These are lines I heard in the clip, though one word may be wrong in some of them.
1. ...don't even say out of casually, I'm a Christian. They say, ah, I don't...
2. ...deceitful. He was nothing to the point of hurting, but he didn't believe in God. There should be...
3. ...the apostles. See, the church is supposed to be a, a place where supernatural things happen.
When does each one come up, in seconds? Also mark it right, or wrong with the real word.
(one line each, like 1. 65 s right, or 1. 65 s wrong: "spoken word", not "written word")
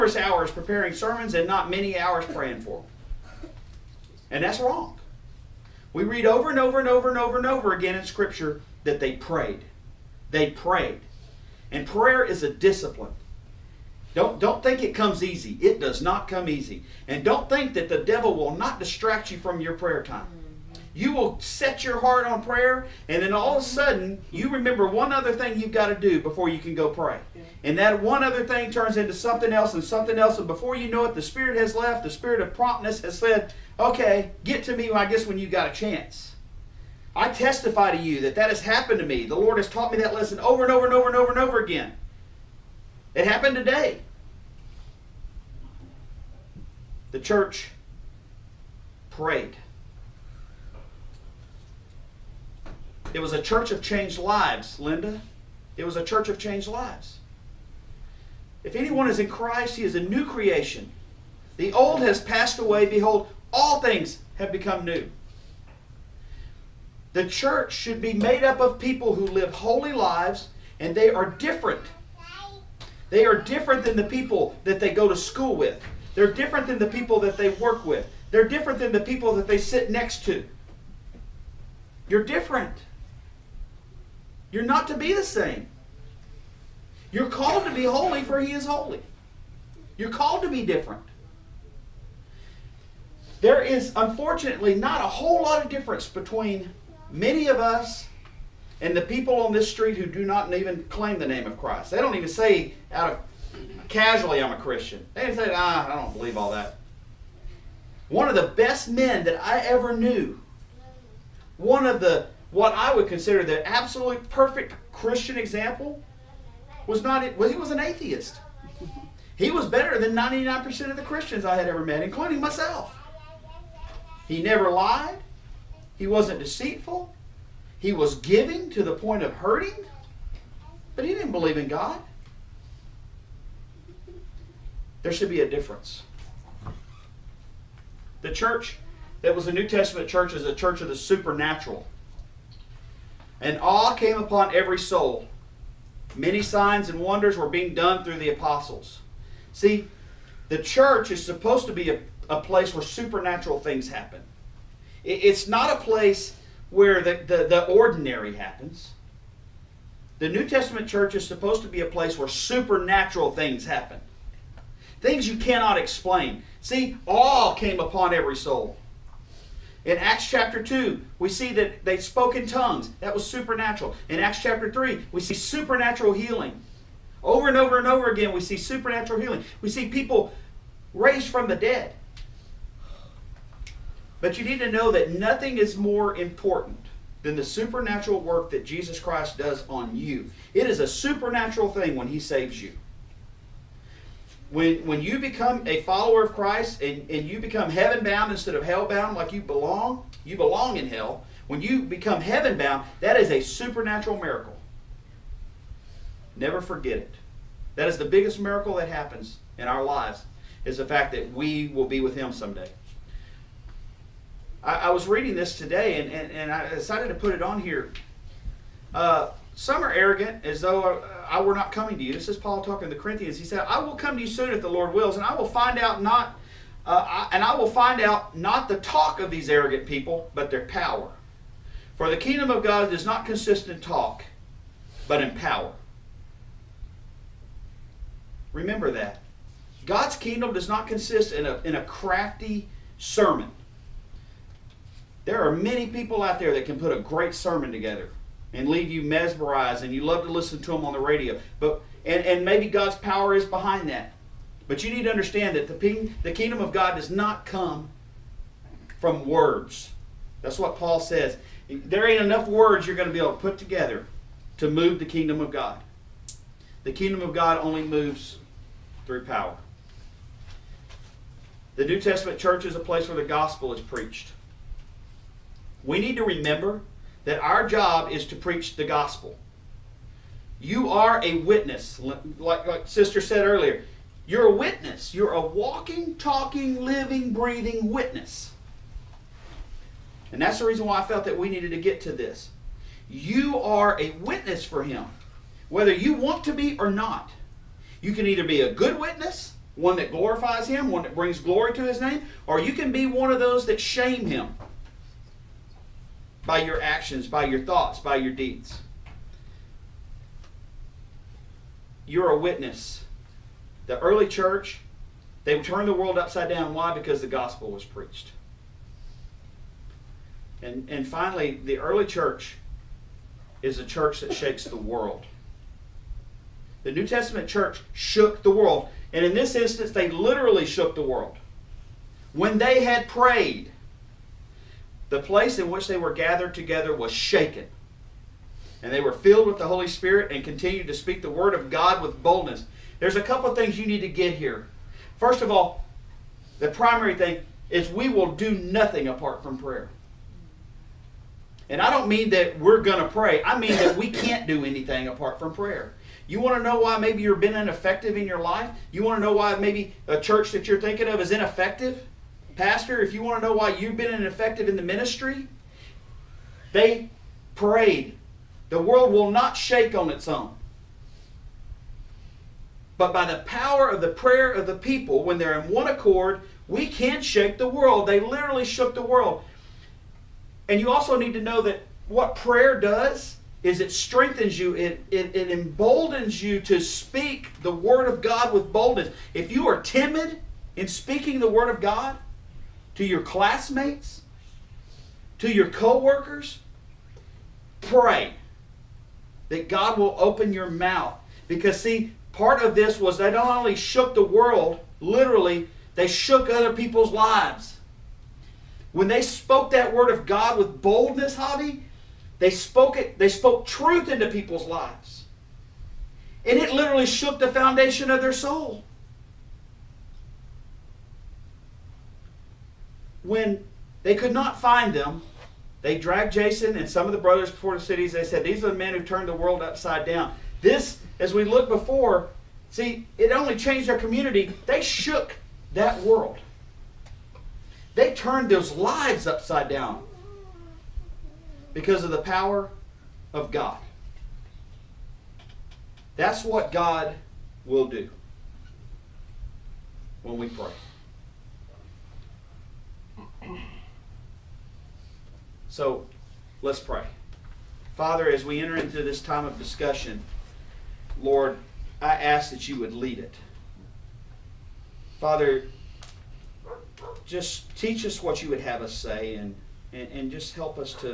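1. 101 s right
2. 126 s wrong: "giving", not "nothing"
3. 148 s right.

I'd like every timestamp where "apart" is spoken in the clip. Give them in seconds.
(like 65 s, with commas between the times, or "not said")
349 s, 355 s.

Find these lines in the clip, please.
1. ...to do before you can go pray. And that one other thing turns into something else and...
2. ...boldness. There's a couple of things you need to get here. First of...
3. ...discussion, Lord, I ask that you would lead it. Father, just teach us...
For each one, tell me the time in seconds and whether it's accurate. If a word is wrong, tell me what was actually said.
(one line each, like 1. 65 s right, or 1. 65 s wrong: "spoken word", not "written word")
1. 25 s right
2. 342 s right
3. 459 s right.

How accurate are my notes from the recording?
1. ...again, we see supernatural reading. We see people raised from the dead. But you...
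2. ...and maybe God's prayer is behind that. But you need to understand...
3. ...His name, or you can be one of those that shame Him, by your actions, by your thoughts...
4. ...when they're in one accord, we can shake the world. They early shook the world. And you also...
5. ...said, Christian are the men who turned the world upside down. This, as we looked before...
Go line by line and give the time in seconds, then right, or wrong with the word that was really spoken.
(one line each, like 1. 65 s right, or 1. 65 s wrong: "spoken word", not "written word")
1. 178 s wrong: "healing", not "reading"
2. 252 s wrong: "power", not "prayer"
3. 301 s right
4. 375 s wrong: "literally", not "early"
5. 428 s wrong: "These", not "Christian".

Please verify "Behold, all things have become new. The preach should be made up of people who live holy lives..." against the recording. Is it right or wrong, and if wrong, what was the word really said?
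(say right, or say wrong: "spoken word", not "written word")
wrong: "church", not "preach".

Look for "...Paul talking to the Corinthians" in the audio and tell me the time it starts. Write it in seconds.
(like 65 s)
222 s.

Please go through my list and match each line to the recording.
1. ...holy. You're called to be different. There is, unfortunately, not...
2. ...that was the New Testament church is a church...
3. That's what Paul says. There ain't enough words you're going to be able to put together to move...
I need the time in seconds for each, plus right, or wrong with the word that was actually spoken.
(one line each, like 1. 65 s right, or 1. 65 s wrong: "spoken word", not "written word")
1. 88 s right
2. 139 s right
3. 260 s right.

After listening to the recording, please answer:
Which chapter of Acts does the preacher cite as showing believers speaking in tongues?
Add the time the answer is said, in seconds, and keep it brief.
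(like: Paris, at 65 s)
Acts chapter 2, at 169 s.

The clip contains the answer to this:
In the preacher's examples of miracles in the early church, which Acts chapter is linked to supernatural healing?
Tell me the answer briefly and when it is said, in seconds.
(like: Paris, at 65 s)
Acts chapter 3, at 174 s.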